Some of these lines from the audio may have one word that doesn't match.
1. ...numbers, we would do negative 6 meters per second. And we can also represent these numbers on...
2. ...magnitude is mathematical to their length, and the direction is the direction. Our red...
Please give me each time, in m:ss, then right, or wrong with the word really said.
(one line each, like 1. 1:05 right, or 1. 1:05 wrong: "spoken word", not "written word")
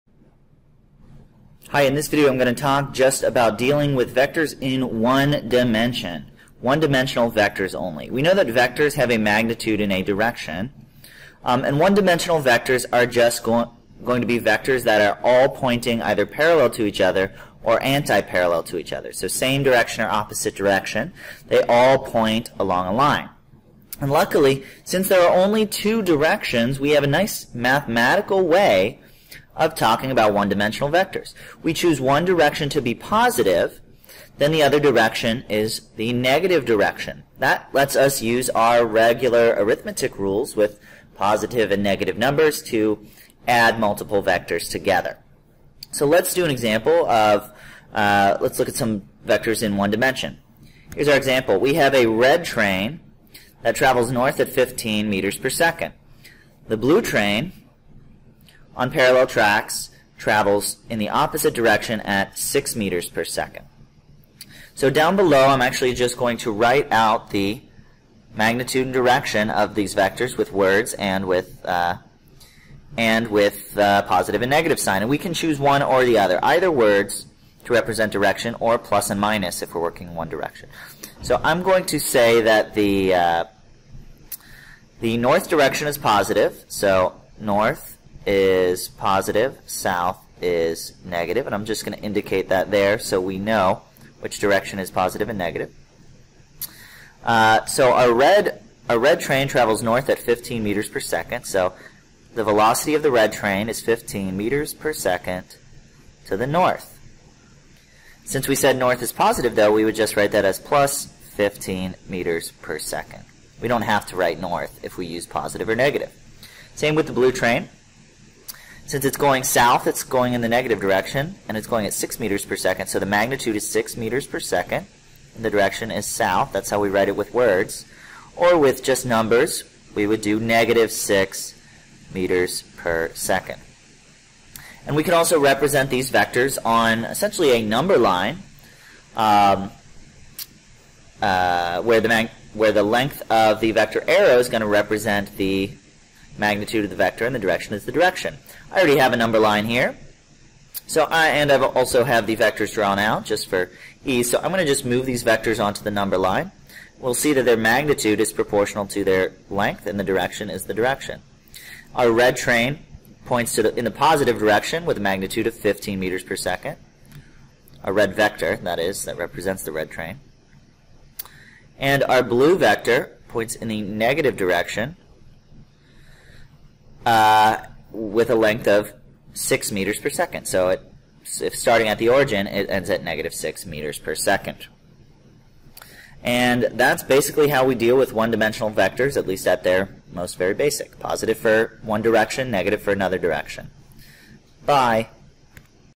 1. 2:09 wrong: "vectors", not "numbers"
2. 2:37 wrong: "proportional", not "mathematical".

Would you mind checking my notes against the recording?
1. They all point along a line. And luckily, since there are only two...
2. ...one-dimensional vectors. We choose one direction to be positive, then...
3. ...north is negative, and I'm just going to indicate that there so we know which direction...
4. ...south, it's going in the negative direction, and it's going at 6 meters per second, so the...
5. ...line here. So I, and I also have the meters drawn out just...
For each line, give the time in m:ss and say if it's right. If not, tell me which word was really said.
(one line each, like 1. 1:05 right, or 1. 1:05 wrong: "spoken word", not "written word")
1. 0:21 right
2. 0:30 right
3. 1:29 wrong: "south", not "north"
4. 1:59 right
5. 2:29 wrong: "vectors", not "meters".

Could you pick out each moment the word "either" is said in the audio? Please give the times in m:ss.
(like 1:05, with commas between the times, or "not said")
0:16, 1:16.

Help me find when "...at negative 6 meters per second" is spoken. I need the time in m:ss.
3:02.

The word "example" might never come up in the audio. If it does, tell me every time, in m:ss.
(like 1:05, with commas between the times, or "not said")
0:46, 0:51.